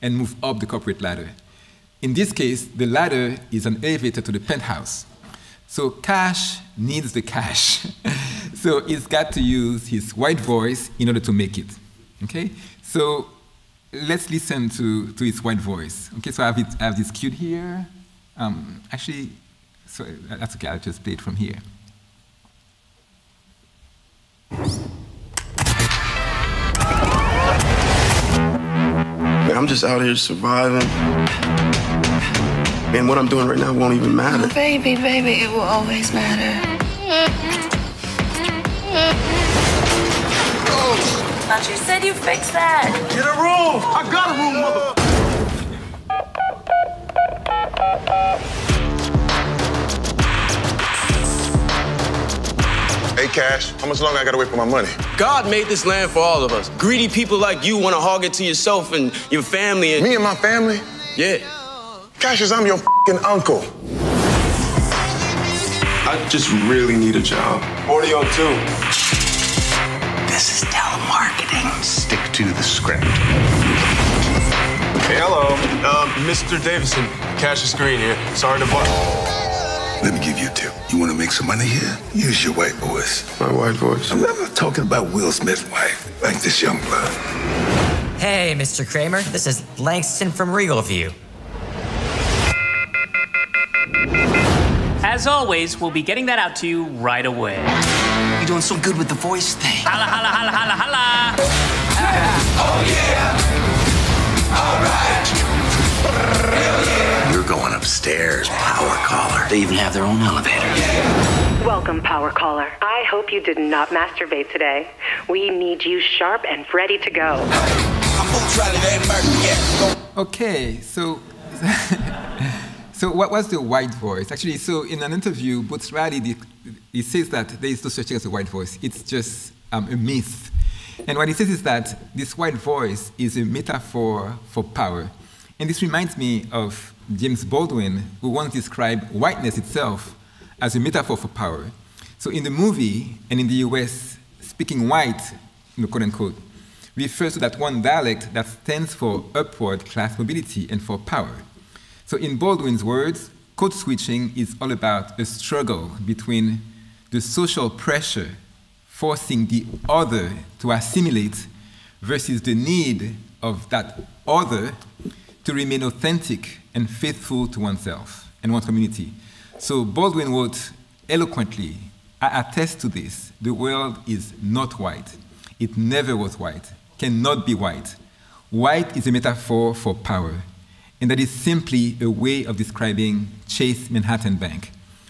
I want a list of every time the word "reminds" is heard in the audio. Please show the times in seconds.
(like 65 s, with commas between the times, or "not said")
135 s.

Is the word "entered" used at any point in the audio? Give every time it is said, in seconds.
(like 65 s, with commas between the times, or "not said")
not said.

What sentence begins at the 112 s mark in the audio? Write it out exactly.
I hope you did not masturbate today.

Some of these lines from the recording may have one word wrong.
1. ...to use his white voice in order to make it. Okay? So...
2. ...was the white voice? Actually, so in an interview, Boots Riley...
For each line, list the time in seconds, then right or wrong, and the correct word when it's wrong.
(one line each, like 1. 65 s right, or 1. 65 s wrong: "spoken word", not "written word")
1. 9 s right
2. 123 s right.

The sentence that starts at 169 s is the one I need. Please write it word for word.
So Baldwin wrote eloquently, I attest to this, the world is not white.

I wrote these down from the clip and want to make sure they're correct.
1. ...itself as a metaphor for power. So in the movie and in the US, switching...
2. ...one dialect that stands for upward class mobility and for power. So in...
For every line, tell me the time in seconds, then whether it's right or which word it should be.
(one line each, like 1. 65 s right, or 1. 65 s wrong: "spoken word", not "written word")
1. 139 s wrong: "speaking", not "switching"
2. 147 s right.